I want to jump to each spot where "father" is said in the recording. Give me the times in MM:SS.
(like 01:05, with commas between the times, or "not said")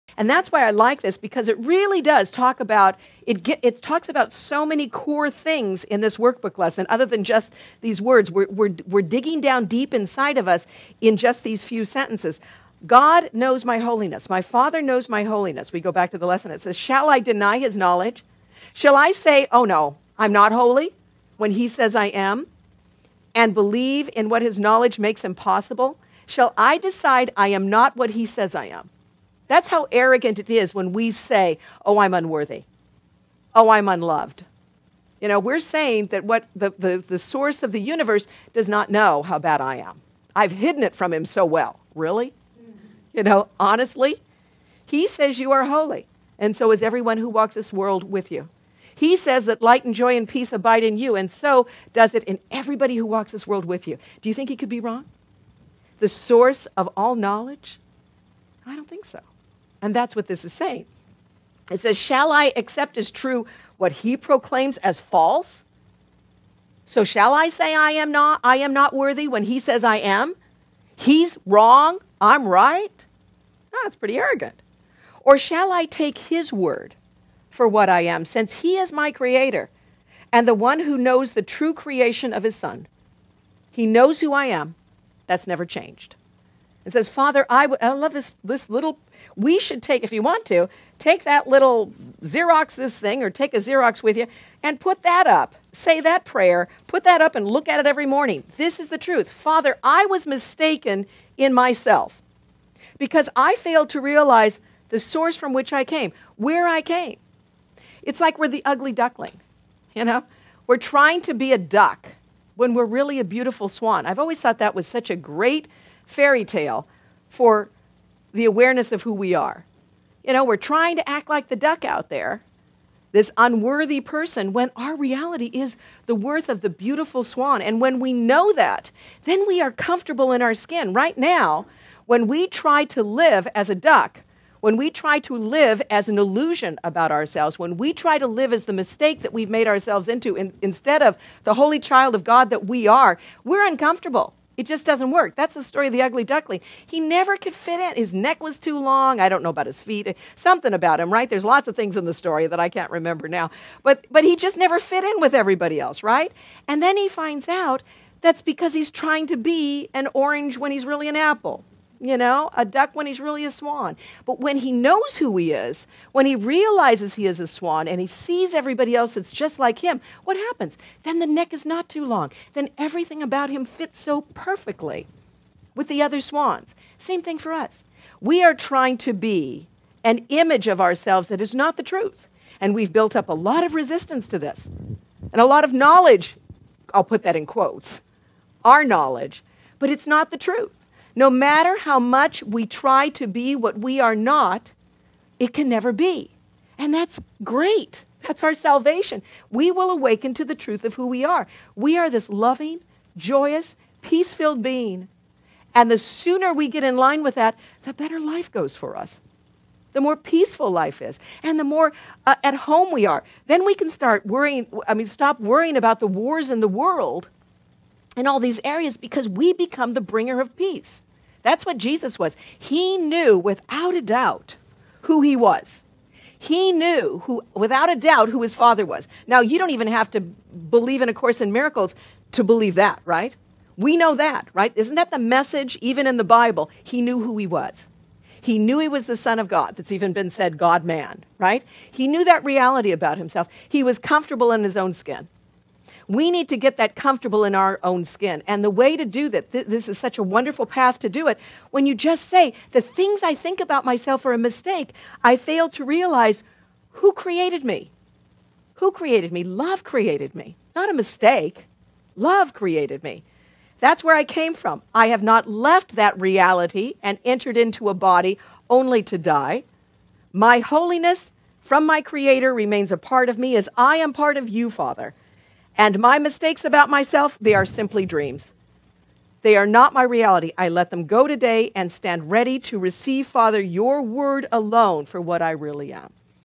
00:14, 01:27, 01:39, 03:48, 04:34, 04:43.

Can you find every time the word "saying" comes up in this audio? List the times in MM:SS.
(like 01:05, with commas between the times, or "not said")
00:35, 01:00.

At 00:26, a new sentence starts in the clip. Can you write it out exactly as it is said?
Shall I decide I am not what he says I am?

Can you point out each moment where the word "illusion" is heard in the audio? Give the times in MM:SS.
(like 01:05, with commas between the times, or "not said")
02:16.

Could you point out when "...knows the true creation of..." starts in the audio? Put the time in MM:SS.
01:20.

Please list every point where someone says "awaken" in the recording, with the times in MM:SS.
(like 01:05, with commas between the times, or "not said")
03:19.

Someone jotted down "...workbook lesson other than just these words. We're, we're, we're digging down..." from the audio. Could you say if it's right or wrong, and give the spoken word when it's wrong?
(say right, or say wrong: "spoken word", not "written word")
right.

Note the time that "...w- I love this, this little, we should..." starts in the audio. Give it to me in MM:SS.
01:27.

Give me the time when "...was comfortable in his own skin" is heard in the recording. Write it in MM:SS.
04:03.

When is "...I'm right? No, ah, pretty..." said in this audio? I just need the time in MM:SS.
01:12.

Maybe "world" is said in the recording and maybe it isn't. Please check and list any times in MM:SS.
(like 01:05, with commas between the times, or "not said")
00:47, 00:53, 03:36.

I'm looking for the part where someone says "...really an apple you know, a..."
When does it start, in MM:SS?
02:40.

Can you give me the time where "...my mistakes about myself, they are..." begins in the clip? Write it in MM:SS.
04:35.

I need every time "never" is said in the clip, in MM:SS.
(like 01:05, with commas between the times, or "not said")
01:25, 02:26, 02:34, 03:15.